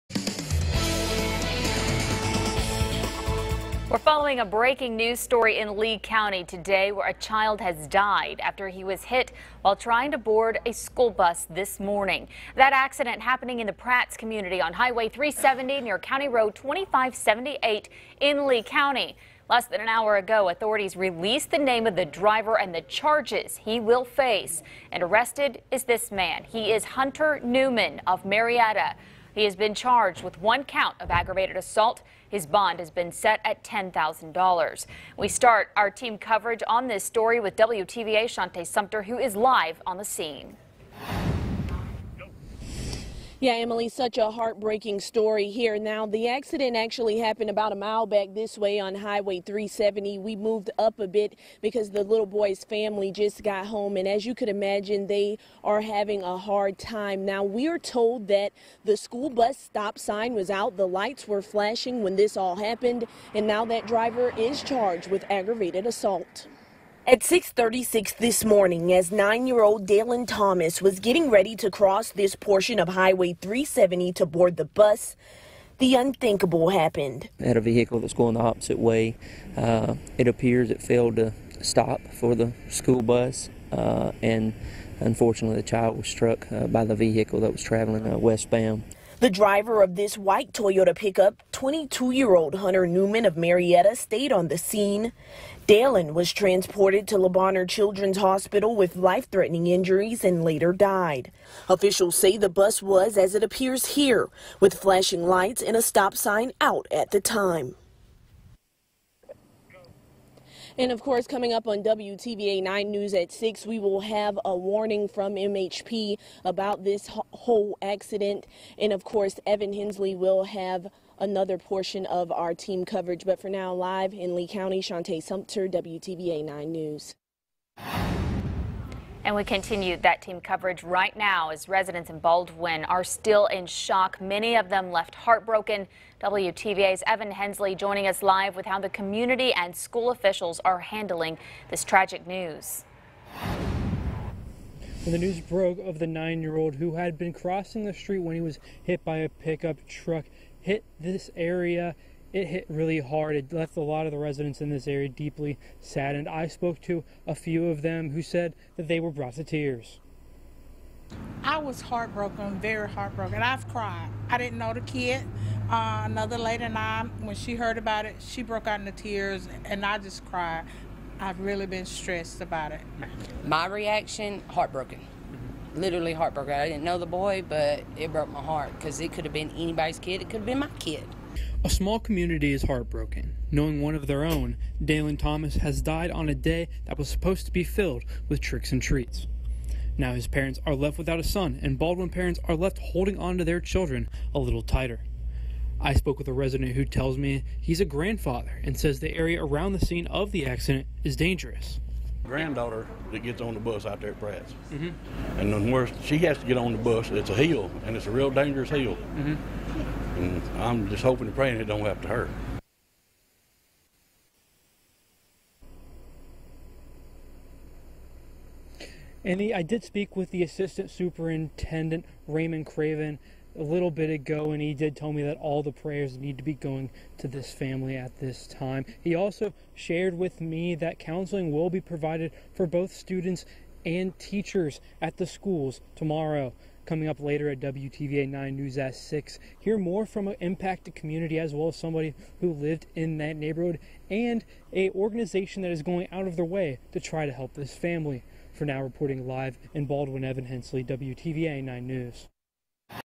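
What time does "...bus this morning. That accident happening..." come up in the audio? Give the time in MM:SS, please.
00:11.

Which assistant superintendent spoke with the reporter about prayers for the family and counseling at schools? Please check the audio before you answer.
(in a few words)
Raymond Craven.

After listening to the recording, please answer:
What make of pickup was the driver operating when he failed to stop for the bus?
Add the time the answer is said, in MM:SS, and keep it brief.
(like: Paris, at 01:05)
Toyota, at 01:30.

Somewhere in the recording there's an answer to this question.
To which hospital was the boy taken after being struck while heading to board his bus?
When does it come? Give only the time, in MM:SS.
01:37.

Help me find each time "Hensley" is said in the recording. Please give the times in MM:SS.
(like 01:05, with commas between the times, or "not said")
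01:59, 02:17, 04:10.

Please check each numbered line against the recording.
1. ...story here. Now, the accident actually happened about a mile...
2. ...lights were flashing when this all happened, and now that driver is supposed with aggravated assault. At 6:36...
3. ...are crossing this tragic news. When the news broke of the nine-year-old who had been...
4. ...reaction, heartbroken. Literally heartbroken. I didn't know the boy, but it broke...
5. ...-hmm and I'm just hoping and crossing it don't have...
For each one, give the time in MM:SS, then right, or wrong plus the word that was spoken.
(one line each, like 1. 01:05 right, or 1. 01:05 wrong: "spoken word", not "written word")
1. 00:44 right
2. 01:00 wrong: "charged", not "supposed"
3. 02:20 wrong: "handling", not "crossing"
4. 02:53 right
5. 03:29 wrong: "praying", not "crossing".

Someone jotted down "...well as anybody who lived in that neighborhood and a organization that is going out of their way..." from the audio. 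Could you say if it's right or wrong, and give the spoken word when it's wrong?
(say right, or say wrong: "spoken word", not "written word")
wrong: "somebody", not "anybody".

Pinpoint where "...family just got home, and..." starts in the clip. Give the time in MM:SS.
00:52.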